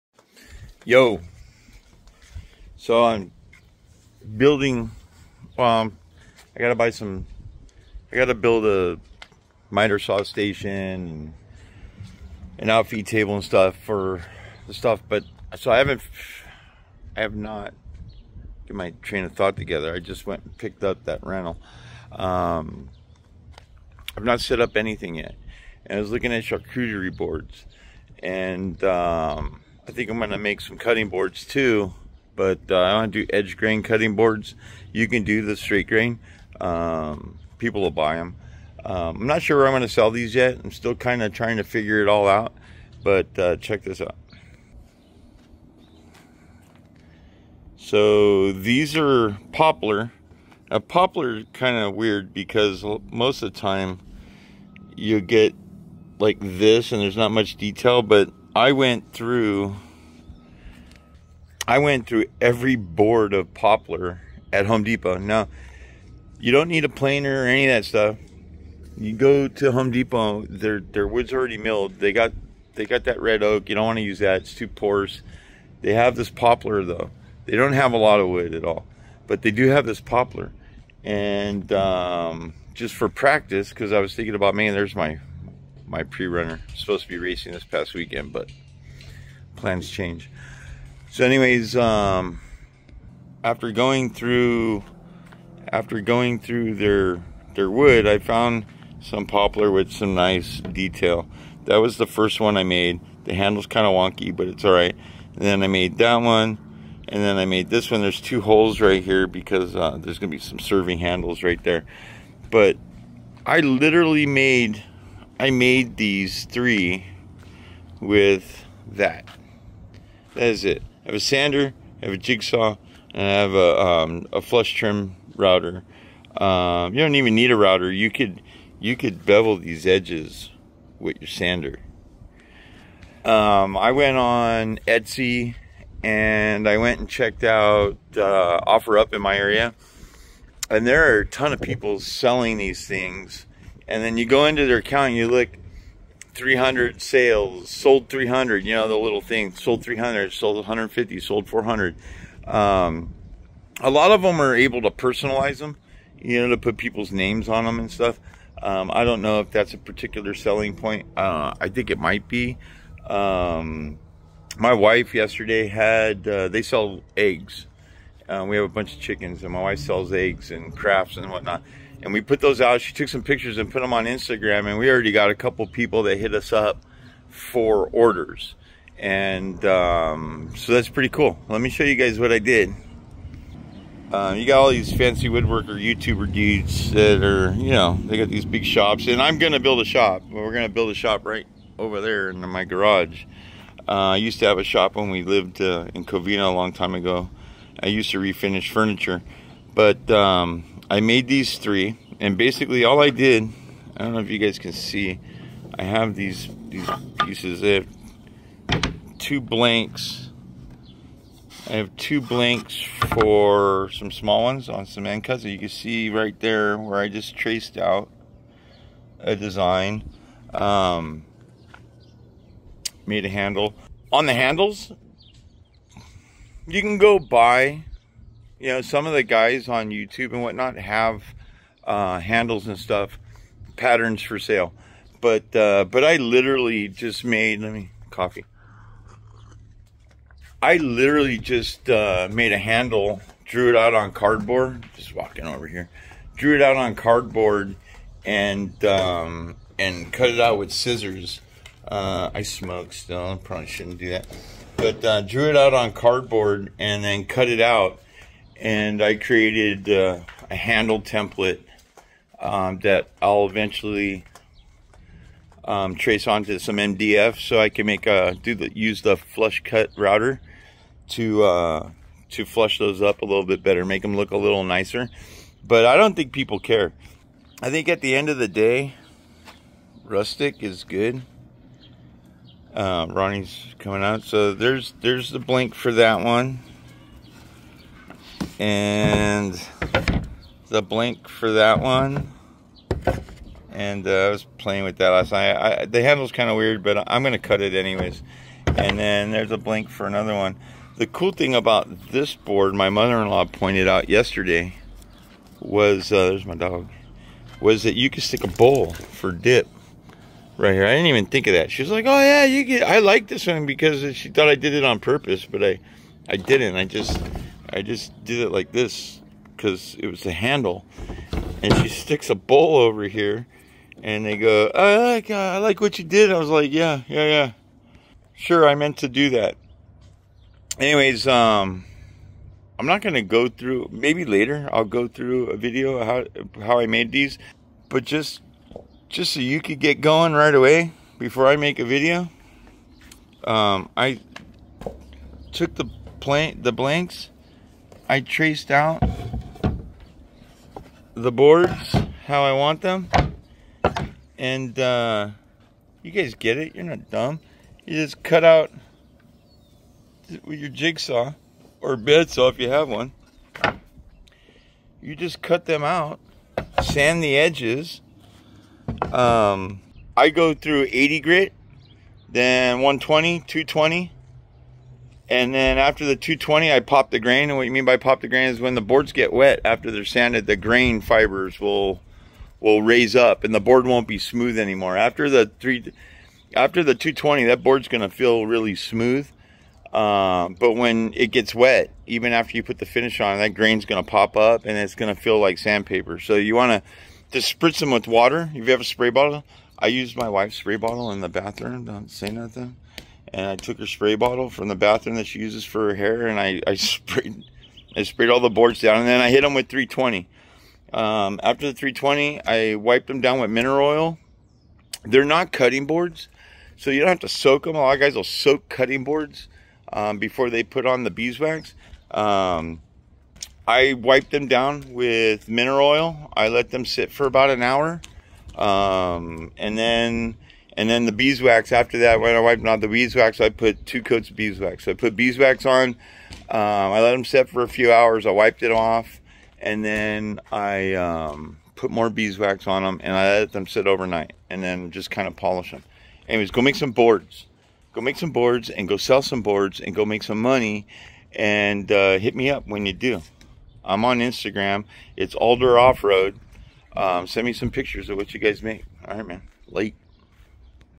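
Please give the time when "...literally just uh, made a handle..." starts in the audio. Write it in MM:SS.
04:00.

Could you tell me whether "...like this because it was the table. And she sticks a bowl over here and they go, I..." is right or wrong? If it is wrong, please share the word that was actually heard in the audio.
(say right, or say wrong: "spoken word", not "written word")
wrong: "handle", not "table".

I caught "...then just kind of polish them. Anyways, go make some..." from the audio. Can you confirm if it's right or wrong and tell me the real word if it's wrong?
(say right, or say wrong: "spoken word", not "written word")
right.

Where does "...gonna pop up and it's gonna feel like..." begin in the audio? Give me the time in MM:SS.
06:33.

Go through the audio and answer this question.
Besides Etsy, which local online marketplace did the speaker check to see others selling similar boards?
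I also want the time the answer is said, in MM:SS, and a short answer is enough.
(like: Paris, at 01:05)
OfferUp, at 02:18.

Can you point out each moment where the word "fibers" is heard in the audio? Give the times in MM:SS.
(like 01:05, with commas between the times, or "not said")
06:20.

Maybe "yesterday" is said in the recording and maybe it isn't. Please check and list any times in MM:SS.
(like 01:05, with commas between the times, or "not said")
02:45, 05:04.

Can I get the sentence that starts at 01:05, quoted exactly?
Now, you don't need a planer or any of that stuff.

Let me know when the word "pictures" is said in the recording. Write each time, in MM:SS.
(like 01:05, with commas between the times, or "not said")
02:53, 07:37.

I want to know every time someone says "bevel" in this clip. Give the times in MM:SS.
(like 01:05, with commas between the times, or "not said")
02:09.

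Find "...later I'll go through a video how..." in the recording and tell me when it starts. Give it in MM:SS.
05:34.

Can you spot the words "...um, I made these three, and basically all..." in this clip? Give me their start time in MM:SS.
03:20.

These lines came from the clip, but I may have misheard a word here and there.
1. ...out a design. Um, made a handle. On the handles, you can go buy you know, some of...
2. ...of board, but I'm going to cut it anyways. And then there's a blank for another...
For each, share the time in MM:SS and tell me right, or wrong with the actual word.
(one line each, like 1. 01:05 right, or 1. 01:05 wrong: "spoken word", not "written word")
1. 03:37 right
2. 04:56 wrong: "weird", not "board".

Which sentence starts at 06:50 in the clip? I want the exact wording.
Um, after the 320, I wiped them down with mineral oil.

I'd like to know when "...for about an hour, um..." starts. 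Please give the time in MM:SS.
07:07.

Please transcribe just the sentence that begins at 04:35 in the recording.
But I don't think people care.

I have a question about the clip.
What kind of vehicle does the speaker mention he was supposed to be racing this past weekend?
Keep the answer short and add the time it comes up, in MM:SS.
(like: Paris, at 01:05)
pre-runner, at 01:26.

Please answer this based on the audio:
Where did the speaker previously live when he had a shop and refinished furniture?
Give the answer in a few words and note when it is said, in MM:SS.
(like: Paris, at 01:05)
Covina, at 03:16.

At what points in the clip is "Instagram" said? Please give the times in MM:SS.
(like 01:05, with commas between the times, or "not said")
02:54, 07:34.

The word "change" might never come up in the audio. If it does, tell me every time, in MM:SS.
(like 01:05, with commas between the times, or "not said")
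01:29.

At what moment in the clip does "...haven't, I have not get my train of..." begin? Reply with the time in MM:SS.
00:15.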